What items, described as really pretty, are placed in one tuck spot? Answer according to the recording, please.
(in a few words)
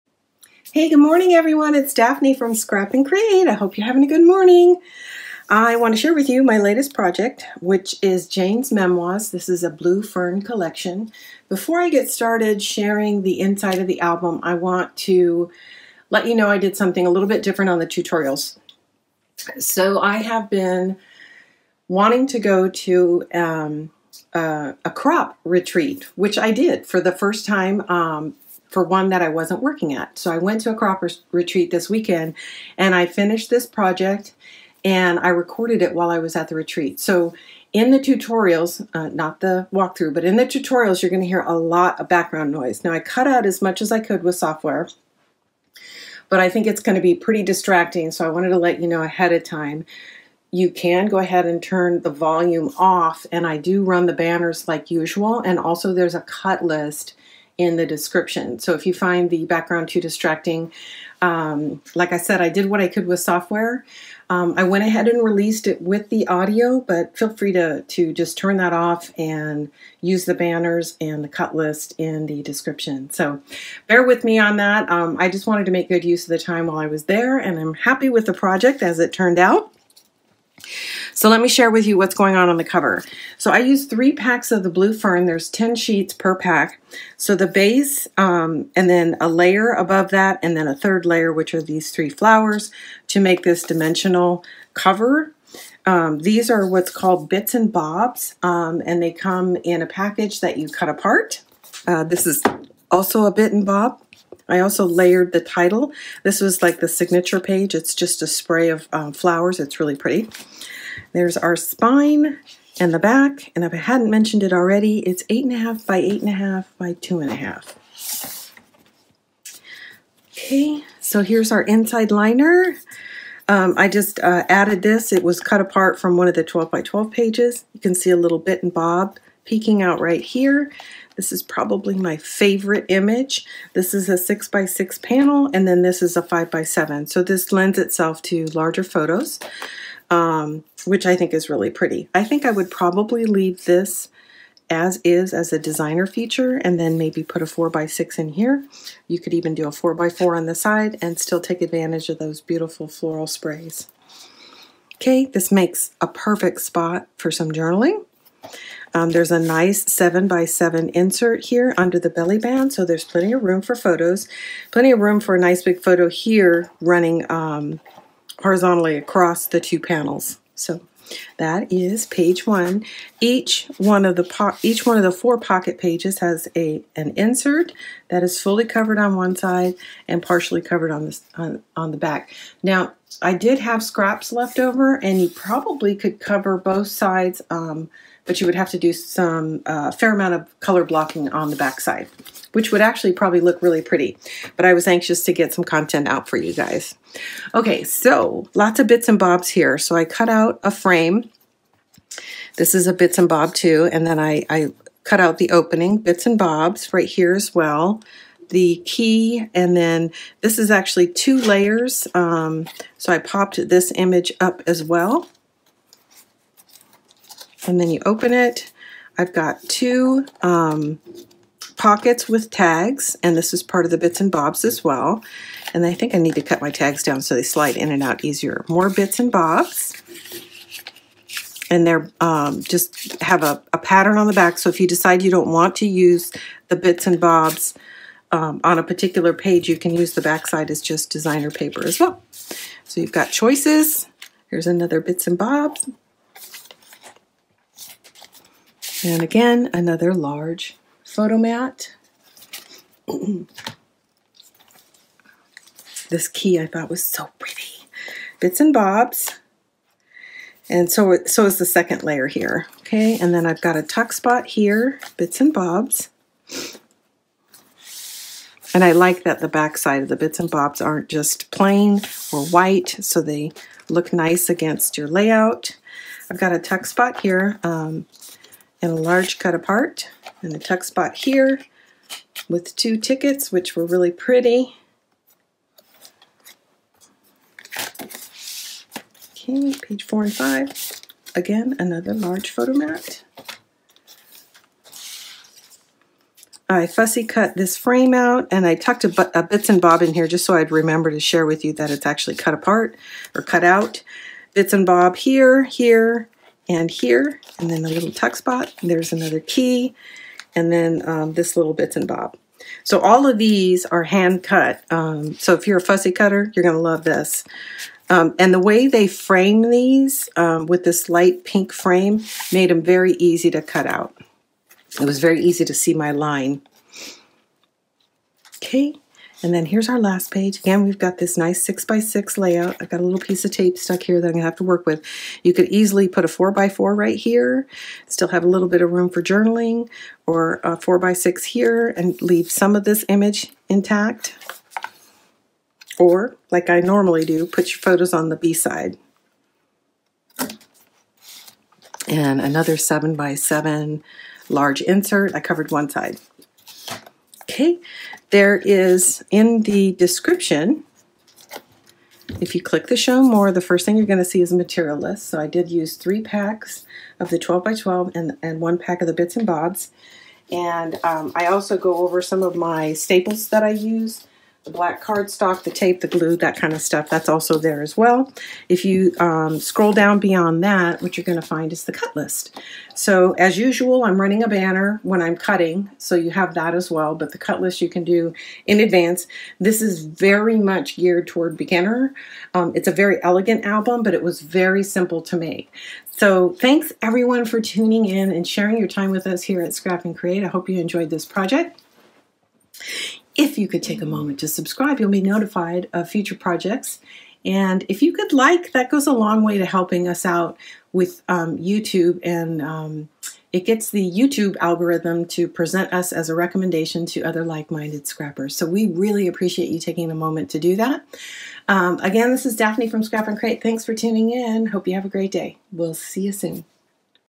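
two tickets.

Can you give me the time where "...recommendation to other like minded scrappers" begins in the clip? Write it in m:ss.
6:56.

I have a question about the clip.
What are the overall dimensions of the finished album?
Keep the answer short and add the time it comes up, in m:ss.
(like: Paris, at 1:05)
8.5 x 8.5 x 2.5, at 1:55.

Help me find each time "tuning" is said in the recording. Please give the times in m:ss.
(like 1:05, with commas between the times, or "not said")
6:37, 7:03.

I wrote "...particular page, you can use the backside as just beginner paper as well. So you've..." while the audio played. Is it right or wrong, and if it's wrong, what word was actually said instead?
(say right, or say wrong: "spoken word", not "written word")
wrong: "designer", not "beginner".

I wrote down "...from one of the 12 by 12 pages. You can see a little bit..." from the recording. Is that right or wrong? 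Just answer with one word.
right.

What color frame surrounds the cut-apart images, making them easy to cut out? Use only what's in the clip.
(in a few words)
light pink.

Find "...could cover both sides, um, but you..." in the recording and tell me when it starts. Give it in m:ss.
3:05.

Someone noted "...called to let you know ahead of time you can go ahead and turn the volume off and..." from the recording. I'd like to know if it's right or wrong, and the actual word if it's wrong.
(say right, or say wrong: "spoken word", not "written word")
wrong: "wanted", not "called".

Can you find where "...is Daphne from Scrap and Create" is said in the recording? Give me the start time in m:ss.
7:02.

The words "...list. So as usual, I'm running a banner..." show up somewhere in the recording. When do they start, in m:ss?
6:22.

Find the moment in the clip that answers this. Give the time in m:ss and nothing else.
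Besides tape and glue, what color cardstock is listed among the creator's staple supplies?
6:14.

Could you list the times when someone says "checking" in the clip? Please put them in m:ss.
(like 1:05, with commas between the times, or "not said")
not said.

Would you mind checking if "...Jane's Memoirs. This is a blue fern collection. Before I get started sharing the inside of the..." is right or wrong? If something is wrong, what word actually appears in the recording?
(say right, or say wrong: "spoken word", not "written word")
right.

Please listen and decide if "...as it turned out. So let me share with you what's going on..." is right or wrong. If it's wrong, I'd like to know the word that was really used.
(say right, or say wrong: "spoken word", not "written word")
right.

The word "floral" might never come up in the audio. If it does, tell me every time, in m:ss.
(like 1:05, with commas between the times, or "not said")
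2:32.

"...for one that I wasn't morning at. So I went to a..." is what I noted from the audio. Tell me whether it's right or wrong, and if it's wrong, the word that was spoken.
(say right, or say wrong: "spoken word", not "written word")
wrong: "working", not "morning".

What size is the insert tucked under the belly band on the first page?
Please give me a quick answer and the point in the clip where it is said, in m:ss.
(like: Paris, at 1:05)
7x7, at 2:39.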